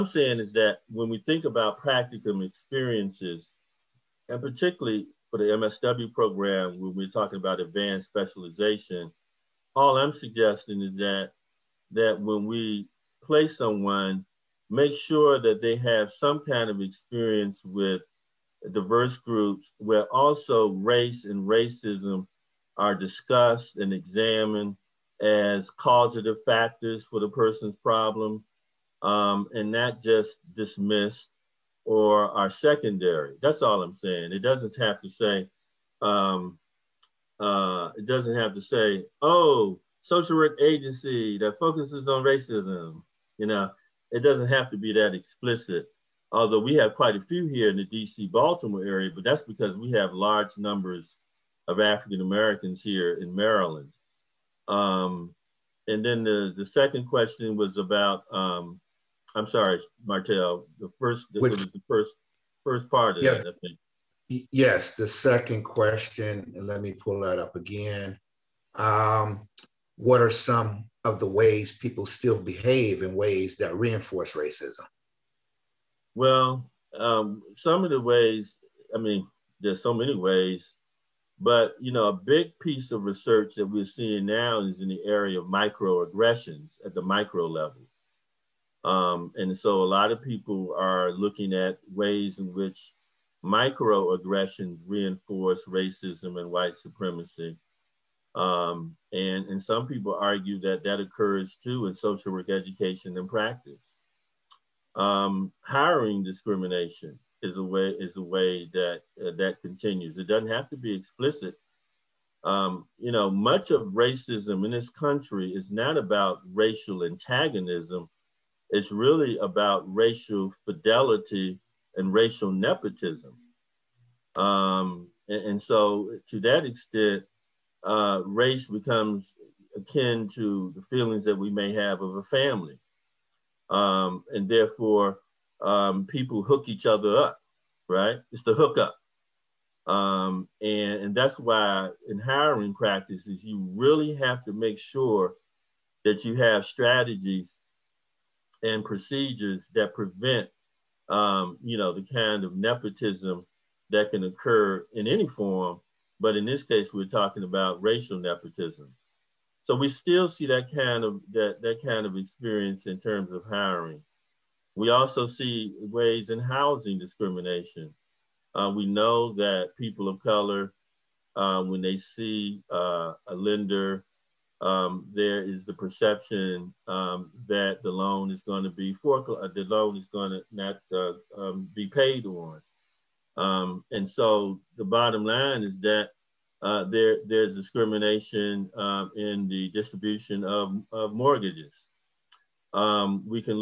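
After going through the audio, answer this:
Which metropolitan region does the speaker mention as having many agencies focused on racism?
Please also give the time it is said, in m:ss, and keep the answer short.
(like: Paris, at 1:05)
DC Baltimore area, at 0:47.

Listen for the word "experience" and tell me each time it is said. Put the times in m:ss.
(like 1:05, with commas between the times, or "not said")
0:02, 0:16, 2:42.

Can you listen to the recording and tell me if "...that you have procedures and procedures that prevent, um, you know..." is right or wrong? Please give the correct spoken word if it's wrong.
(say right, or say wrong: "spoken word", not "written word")
wrong: "strategies", not "procedures".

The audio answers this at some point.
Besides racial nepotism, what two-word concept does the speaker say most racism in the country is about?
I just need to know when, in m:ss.
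1:59.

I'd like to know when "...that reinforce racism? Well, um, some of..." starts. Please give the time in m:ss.
1:13.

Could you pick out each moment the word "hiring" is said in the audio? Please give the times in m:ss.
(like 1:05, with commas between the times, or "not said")
1:45, 2:22, 2:43.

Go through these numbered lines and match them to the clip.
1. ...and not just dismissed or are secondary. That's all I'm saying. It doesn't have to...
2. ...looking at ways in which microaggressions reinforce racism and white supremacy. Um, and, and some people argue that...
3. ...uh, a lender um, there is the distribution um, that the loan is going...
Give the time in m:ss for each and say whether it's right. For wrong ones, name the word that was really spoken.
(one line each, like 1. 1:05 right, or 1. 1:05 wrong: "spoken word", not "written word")
1. 0:29 right
2. 1:31 right
3. 2:52 wrong: "perception", not "distribution".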